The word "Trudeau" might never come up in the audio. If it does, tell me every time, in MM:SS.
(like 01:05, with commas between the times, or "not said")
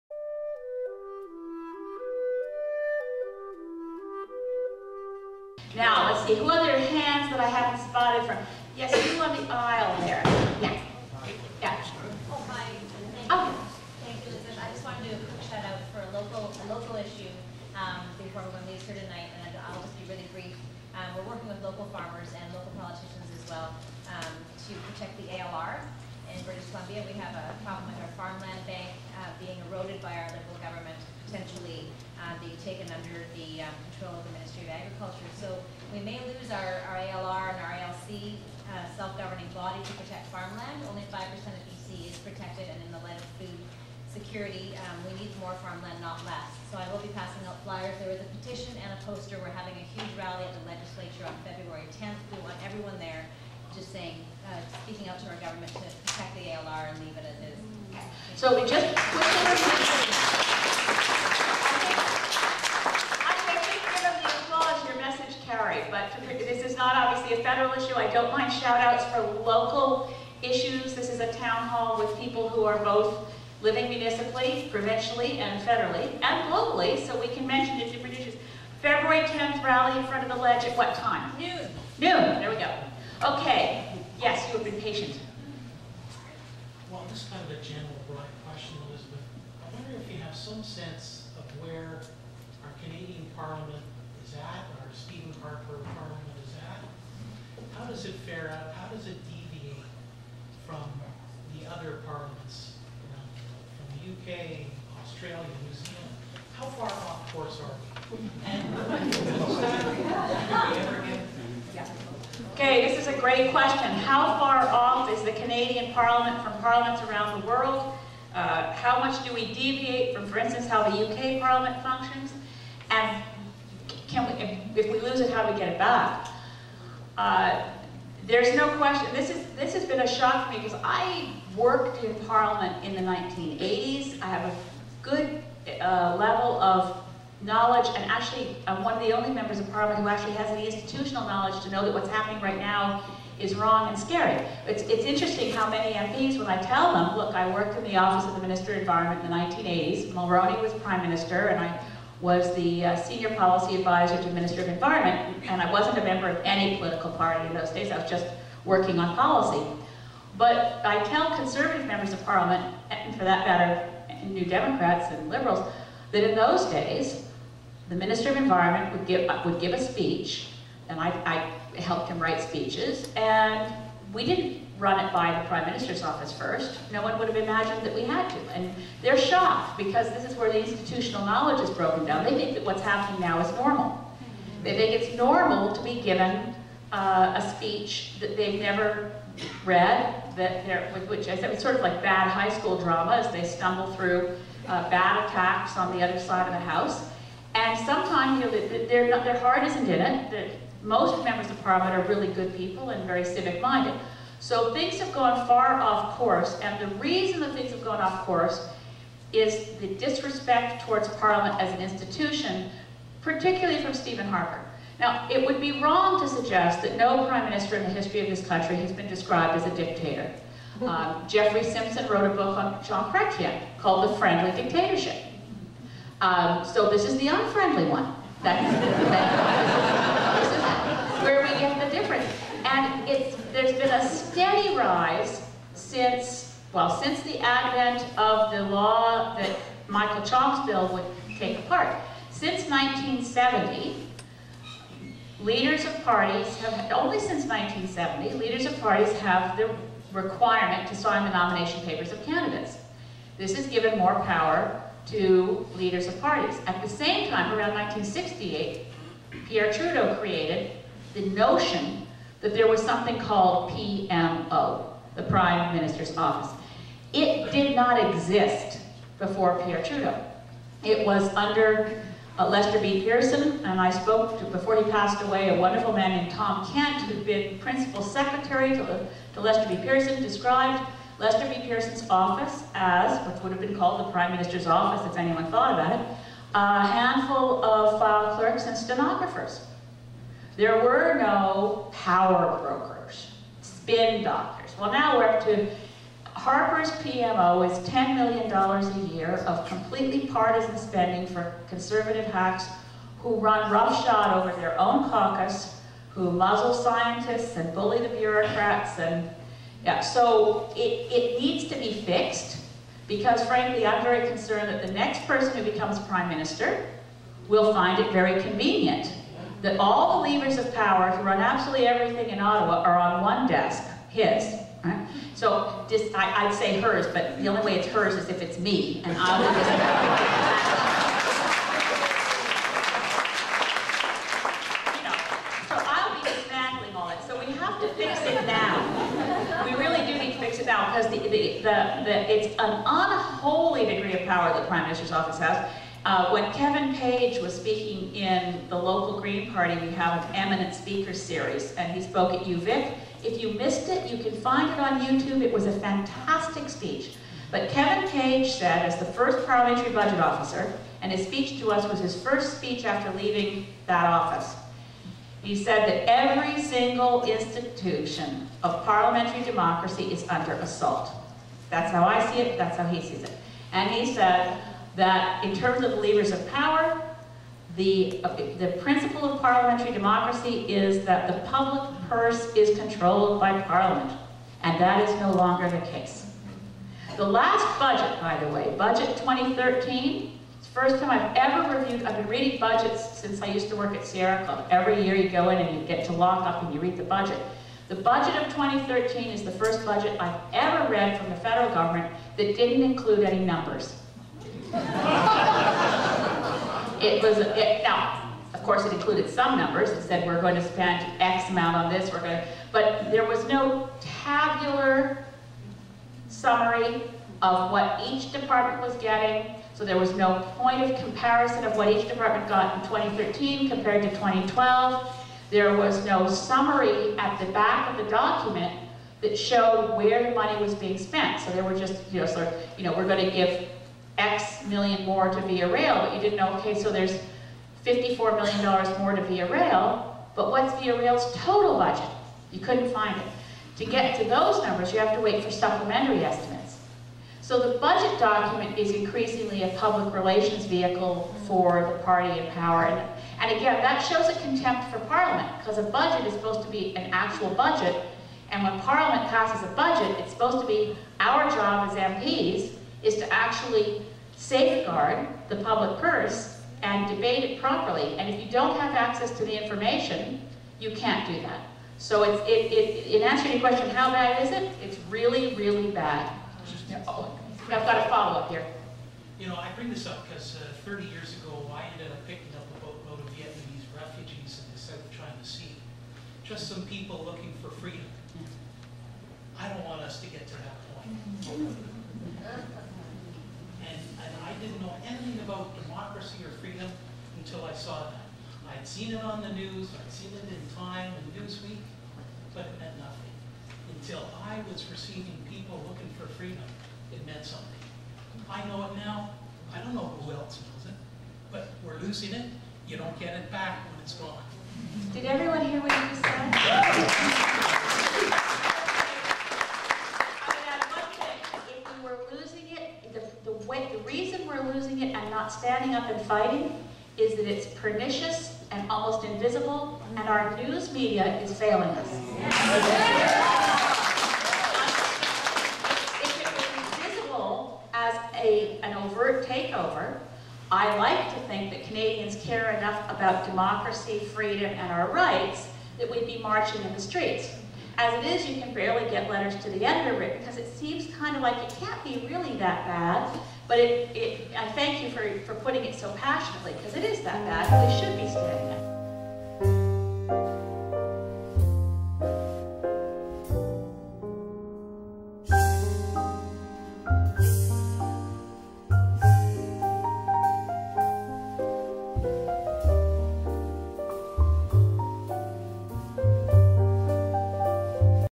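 04:19, 04:29.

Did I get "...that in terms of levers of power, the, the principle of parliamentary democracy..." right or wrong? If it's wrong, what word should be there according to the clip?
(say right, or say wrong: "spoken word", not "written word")
right.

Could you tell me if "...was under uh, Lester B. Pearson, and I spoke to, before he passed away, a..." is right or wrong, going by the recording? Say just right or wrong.
right.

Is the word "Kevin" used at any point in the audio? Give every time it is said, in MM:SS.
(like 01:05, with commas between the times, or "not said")
05:46, 05:57.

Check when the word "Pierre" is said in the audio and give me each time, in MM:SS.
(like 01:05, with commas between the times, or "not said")
04:19, 04:29.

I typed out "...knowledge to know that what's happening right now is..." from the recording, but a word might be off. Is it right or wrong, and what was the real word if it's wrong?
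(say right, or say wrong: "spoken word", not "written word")
right.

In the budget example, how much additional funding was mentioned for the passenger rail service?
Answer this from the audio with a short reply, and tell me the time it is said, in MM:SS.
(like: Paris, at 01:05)
$54 million, at 07:17.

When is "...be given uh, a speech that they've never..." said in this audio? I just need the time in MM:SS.
03:05.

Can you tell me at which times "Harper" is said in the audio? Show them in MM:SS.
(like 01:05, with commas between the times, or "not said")
01:35, 03:34, 04:56.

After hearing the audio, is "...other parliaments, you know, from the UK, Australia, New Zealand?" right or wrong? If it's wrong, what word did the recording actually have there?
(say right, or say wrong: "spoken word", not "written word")
right.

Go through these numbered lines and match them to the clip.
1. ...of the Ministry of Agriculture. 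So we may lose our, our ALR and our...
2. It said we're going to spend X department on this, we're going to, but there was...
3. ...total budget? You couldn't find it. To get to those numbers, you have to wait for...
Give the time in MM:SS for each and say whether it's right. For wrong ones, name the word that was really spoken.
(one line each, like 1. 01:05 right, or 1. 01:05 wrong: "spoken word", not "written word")
1. 00:34 right
2. 06:49 wrong: "amount", not "department"
3. 07:21 right.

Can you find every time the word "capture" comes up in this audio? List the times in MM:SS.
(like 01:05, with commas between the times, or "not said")
not said.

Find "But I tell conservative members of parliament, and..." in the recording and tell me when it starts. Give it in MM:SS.
02:40.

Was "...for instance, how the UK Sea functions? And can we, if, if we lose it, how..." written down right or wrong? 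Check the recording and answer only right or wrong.
wrong.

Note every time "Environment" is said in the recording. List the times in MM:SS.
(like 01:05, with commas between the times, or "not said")
02:28, 02:34, 02:48.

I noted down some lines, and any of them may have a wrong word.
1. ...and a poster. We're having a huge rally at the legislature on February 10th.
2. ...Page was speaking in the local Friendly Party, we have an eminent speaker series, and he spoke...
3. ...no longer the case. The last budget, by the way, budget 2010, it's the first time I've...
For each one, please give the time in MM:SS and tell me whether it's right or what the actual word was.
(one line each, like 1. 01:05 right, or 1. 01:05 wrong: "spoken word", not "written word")
1. 00:48 right
2. 05:46 wrong: "Green", not "Friendly"
3. 06:25 wrong: "2013", not "2010".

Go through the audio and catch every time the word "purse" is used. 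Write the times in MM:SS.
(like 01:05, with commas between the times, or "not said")
06:22, 07:46.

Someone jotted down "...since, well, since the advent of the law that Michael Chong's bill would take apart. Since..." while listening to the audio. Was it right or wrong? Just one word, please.
right.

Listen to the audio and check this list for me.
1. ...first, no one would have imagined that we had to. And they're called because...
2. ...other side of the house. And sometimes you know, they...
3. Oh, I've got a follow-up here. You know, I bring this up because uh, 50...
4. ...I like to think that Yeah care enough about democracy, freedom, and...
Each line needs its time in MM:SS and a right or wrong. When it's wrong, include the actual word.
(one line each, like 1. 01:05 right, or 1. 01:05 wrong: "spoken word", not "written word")
1. 02:56 wrong: "shocked", not "called"
2. 03:16 right
3. 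07:57 wrong: "30", not "50"
4. 09:00 wrong: "Canadians", not "Yeah".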